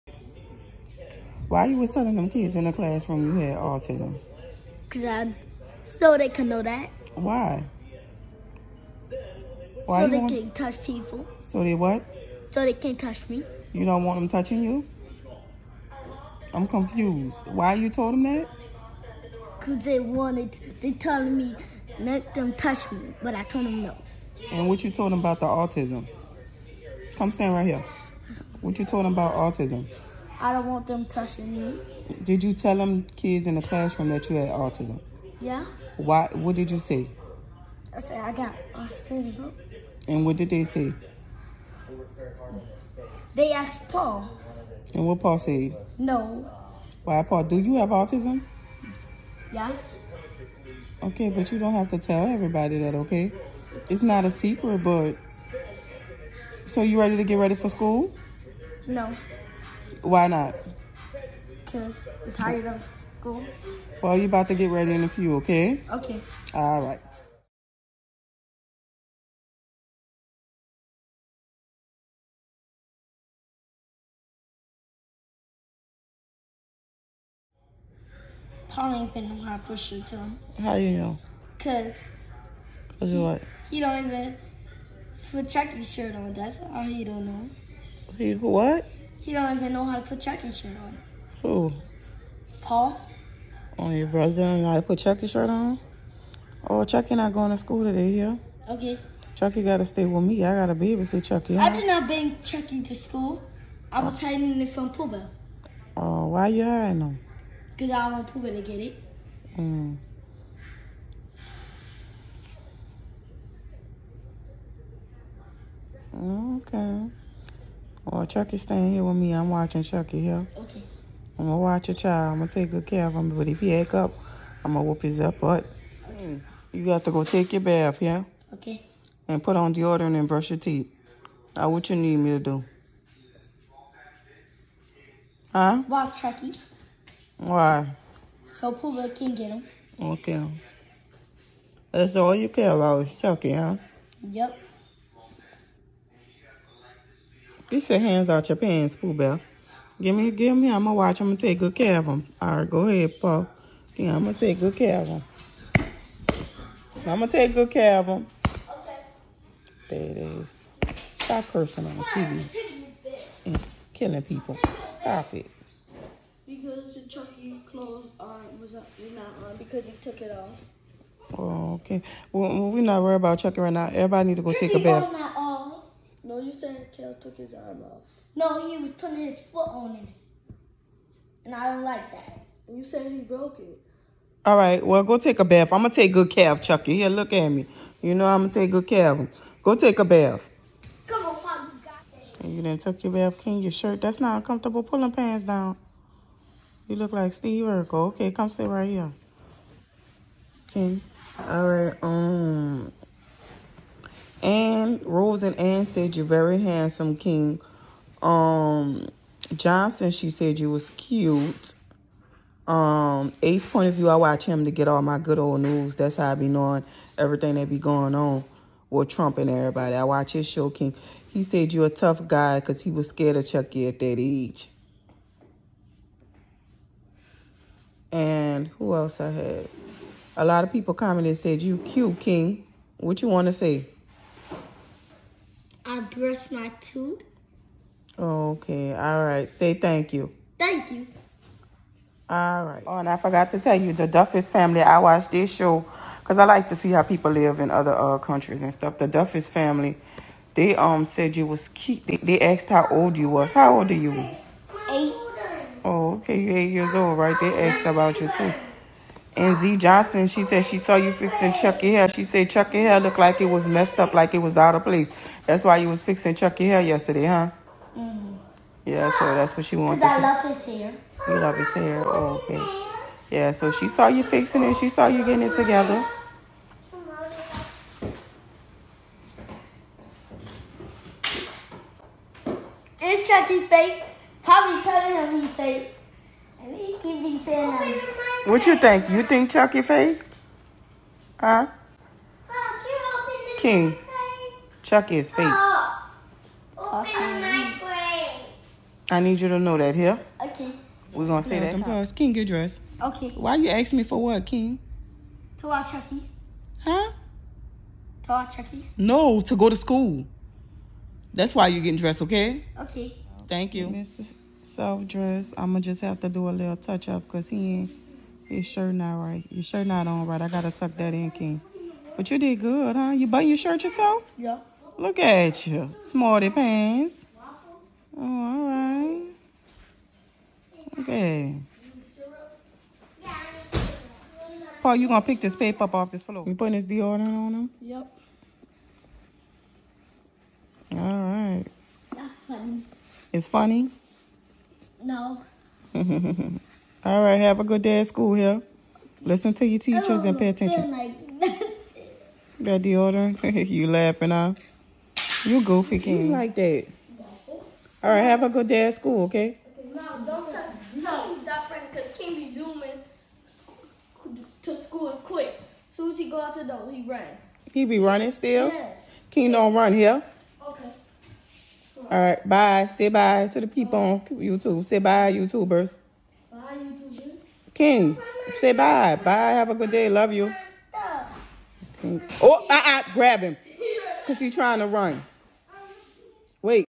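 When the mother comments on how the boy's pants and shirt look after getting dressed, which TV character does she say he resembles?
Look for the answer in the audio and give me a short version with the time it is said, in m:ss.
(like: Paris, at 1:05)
Steve Urkel, at 3:17.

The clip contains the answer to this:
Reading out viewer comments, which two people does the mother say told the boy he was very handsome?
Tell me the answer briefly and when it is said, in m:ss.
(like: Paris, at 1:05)
Rose and Anne, at 3:25.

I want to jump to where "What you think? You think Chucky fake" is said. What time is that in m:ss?
4:48.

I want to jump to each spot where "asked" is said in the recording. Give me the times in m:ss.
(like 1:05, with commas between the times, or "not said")
0:43, 4:12, 4:17.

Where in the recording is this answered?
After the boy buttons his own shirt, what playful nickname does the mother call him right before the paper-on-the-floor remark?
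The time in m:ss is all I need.
5:26.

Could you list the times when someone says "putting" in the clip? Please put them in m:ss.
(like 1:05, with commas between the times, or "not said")
2:58, 5:36.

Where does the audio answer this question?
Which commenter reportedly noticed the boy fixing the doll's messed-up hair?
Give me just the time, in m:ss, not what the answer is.
4:19.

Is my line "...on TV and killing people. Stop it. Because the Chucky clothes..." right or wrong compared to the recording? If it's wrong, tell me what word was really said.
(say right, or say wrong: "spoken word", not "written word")
right.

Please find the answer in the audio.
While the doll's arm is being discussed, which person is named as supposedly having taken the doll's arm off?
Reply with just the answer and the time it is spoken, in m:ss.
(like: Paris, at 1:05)
Kale, at 2:56.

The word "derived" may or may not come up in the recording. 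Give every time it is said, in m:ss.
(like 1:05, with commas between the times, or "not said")
not said.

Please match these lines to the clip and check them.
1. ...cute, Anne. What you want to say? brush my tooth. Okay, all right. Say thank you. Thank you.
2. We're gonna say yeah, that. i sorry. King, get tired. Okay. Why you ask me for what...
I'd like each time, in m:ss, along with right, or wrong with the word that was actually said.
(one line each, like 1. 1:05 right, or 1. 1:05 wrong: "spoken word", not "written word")
1. 3:51 wrong: "King", not "Anne"
2. 5:01 wrong: "dressed", not "tired".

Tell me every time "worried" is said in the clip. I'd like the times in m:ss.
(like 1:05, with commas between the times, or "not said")
2:53.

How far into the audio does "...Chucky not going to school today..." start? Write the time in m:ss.
1:36.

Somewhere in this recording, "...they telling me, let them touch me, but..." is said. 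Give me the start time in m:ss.
0:20.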